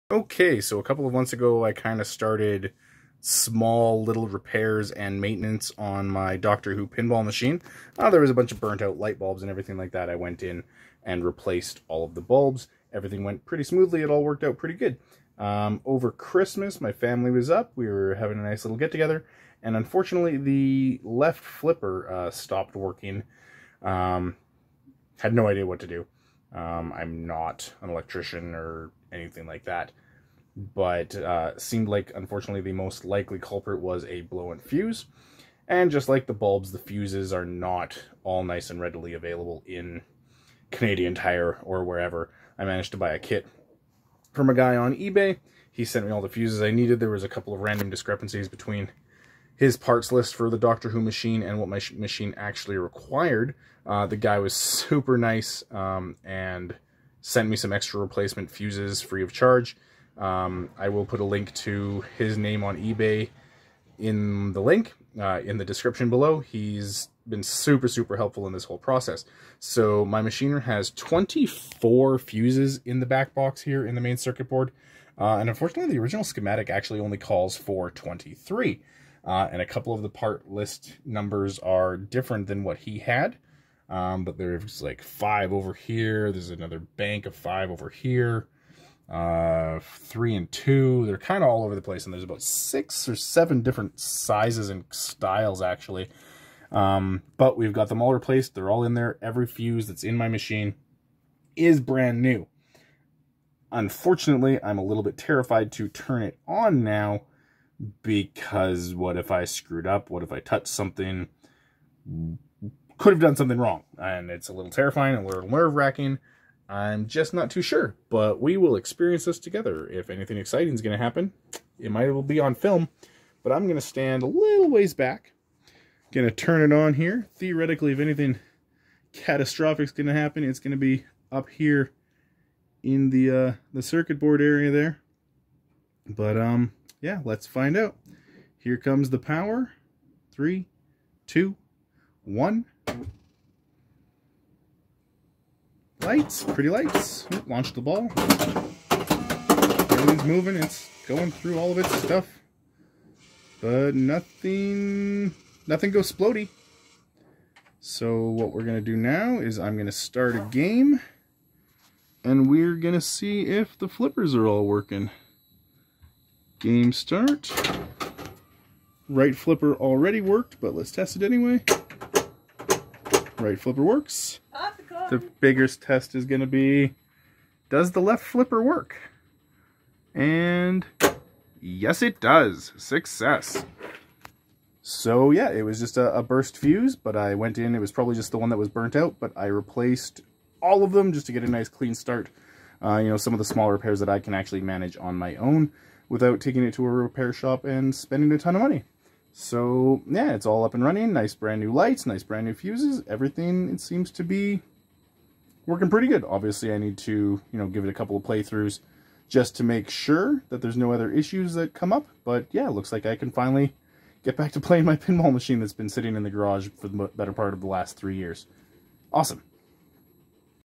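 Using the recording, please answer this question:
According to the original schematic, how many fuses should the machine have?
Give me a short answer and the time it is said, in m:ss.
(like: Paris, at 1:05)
23, at 1:17.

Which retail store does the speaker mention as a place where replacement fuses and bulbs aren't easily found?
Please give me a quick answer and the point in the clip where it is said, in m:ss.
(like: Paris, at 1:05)
Canadian Tire, at 0:40.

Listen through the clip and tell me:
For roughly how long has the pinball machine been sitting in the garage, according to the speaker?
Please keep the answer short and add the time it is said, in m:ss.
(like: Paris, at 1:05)
3 years, at 3:37.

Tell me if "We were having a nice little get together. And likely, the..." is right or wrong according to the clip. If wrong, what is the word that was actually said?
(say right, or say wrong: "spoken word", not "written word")
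wrong: "unfortunately", not "likely".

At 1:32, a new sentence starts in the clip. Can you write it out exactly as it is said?
And there's about six or seven different sizes and styles, actually.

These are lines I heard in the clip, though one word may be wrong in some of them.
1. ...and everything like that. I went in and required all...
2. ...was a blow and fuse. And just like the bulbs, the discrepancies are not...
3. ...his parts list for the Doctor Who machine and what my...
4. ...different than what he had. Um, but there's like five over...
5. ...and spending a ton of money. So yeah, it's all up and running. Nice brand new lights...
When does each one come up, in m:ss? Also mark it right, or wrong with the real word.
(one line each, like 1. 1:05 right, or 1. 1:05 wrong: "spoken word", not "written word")
1. 0:09 wrong: "replaced", not "required"
2. 0:33 wrong: "fuses", not "discrepancies"
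3. 0:49 right
4. 1:21 right
5. 3:17 right.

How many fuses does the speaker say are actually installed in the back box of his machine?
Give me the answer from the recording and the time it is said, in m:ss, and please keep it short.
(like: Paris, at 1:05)
24, at 1:10.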